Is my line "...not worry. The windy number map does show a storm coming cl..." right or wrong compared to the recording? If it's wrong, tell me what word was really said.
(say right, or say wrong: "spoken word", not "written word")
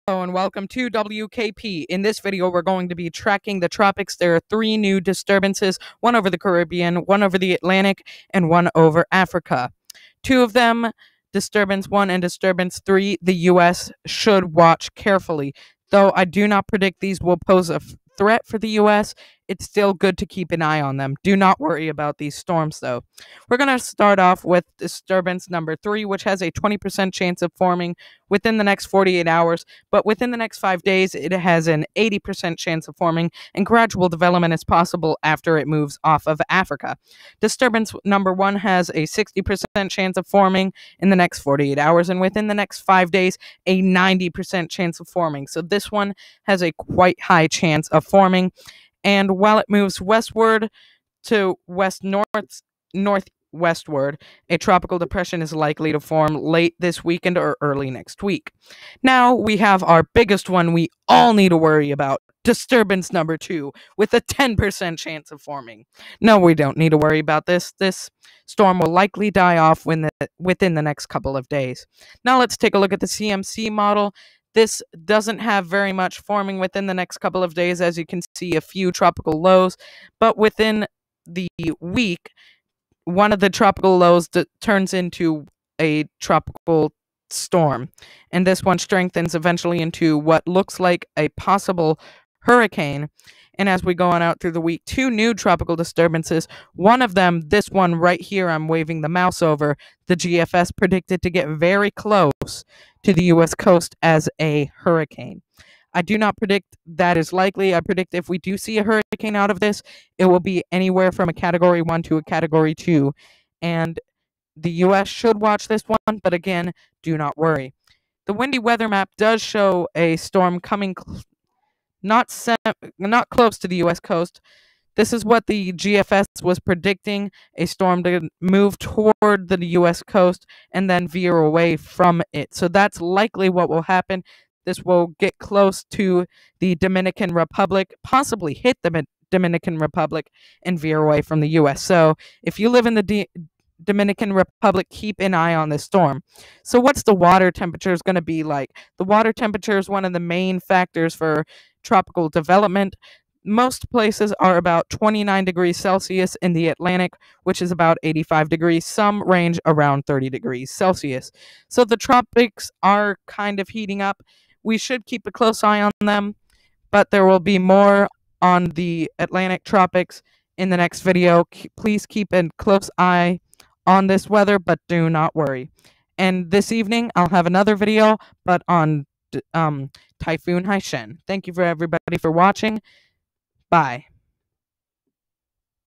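wrong: "weather", not "number".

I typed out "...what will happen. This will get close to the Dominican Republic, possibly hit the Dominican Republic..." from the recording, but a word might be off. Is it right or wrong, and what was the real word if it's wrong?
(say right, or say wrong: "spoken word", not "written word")
right.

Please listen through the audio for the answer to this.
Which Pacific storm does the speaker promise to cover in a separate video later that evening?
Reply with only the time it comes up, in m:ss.
3:00.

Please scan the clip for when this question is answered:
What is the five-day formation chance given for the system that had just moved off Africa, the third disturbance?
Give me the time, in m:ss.
0:31.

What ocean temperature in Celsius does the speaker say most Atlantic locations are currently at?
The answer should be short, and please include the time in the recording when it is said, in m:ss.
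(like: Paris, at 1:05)
29 degrees Celsius, at 2:34.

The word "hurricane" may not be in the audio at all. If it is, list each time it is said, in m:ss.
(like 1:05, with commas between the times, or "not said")
1:32, 1:44, 1:48.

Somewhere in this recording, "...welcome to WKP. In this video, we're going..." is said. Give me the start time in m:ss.
0:00.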